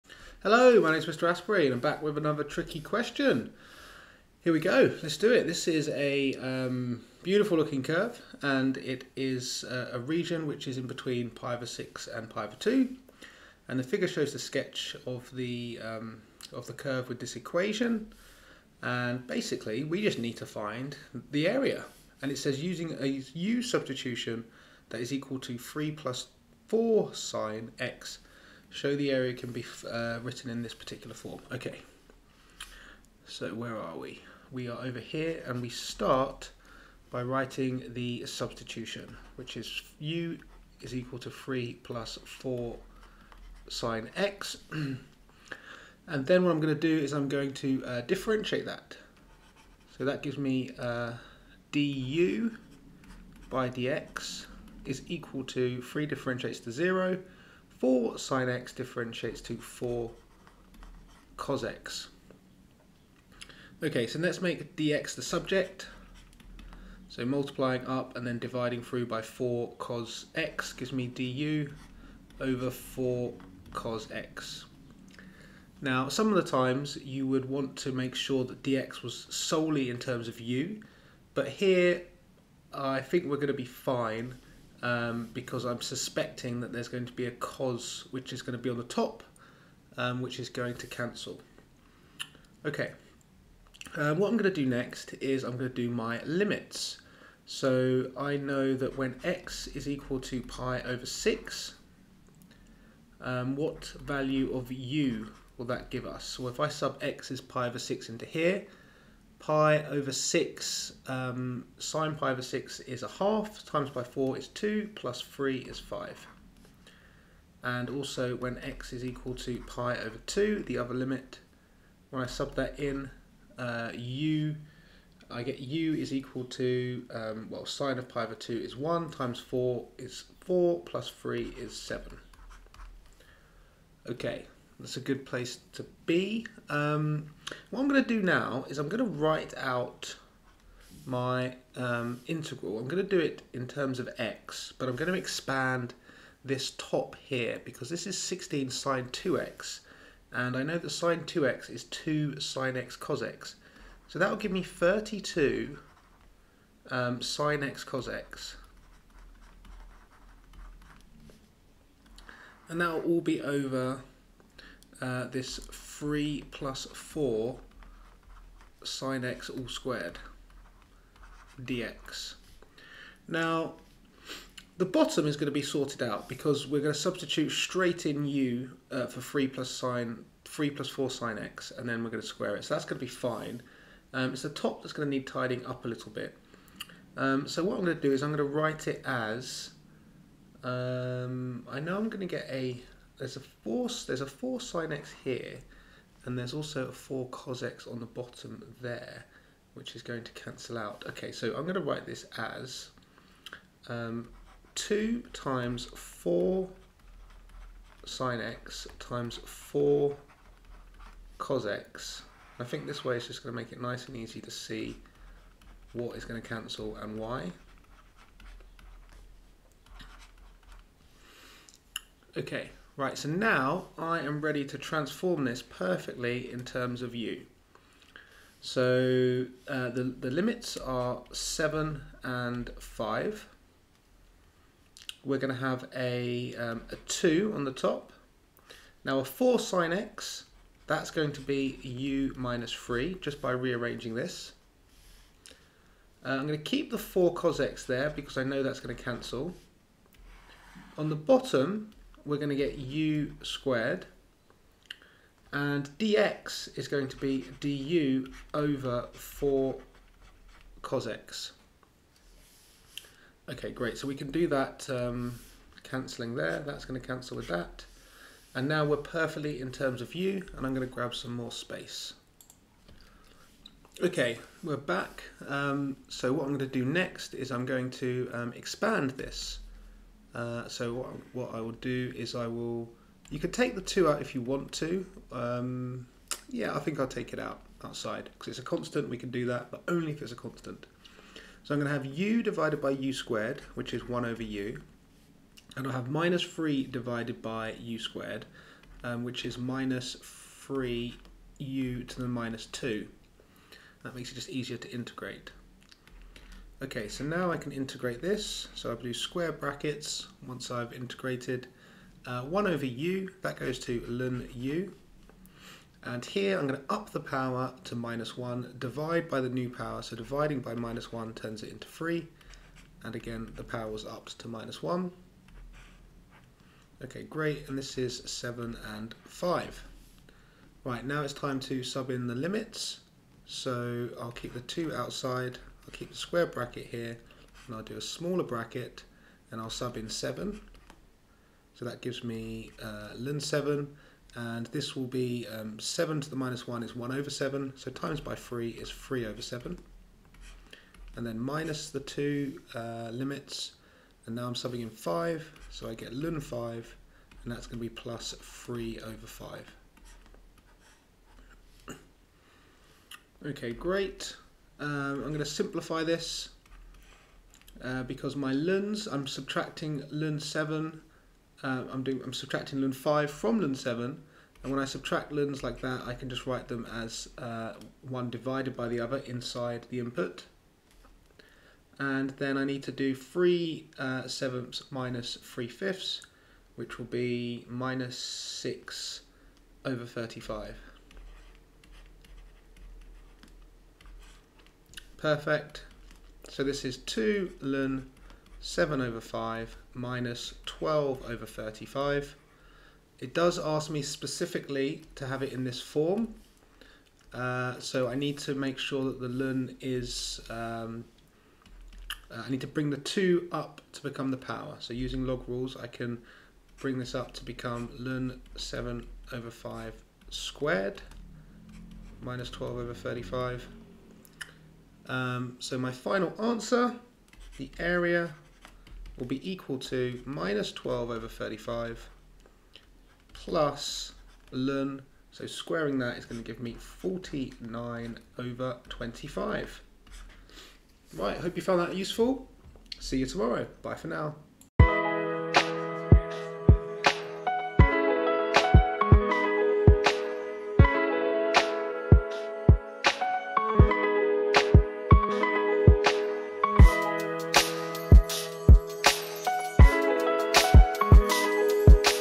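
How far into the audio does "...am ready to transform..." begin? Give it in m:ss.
3:44.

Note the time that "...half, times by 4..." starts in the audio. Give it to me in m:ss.
1:53.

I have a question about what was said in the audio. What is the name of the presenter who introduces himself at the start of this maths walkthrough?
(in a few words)
Mr. Astbury.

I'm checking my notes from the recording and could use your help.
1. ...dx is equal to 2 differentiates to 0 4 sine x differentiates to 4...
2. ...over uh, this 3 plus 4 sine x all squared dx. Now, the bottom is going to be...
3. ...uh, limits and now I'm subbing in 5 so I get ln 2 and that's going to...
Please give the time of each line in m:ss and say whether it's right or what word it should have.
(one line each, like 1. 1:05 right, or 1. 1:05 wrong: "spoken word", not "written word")
1. 0:53 wrong: "3", not "2"
2. 2:43 right
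3. 5:52 wrong: "5", not "2".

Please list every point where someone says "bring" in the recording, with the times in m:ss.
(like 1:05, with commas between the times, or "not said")
6:52, 6:56.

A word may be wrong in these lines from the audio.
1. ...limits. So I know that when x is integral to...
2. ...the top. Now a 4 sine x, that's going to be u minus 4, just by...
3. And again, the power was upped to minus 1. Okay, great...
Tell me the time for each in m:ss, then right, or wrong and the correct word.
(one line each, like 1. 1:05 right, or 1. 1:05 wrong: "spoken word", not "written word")
1. 1:36 wrong: "equal", not "integral"
2. 3:57 wrong: "3", not "4"
3. 5:23 right.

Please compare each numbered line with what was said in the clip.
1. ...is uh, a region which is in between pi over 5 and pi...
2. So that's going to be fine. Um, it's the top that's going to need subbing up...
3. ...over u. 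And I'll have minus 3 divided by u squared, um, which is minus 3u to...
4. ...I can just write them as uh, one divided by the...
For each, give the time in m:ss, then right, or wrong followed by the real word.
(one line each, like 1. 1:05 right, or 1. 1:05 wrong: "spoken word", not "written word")
1. 0:09 wrong: "6", not "5"
2. 3:02 wrong: "tidying", not "subbing"
3. 4:54 right
4. 6:16 right.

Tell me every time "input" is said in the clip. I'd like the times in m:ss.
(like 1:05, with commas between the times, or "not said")
6:19.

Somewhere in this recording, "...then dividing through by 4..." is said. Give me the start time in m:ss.
1:08.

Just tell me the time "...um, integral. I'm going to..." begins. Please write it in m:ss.
2:21.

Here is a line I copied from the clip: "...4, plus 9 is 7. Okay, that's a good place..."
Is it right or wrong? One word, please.
wrong.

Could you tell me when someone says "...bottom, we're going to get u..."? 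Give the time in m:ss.
4:11.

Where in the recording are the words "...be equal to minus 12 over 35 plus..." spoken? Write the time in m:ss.
7:09.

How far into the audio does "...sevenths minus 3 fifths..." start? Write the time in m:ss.
6:24.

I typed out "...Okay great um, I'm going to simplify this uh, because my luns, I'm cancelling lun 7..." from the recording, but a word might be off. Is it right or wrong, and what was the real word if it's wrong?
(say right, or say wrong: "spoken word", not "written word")
wrong: "subtracting", not "cancelling".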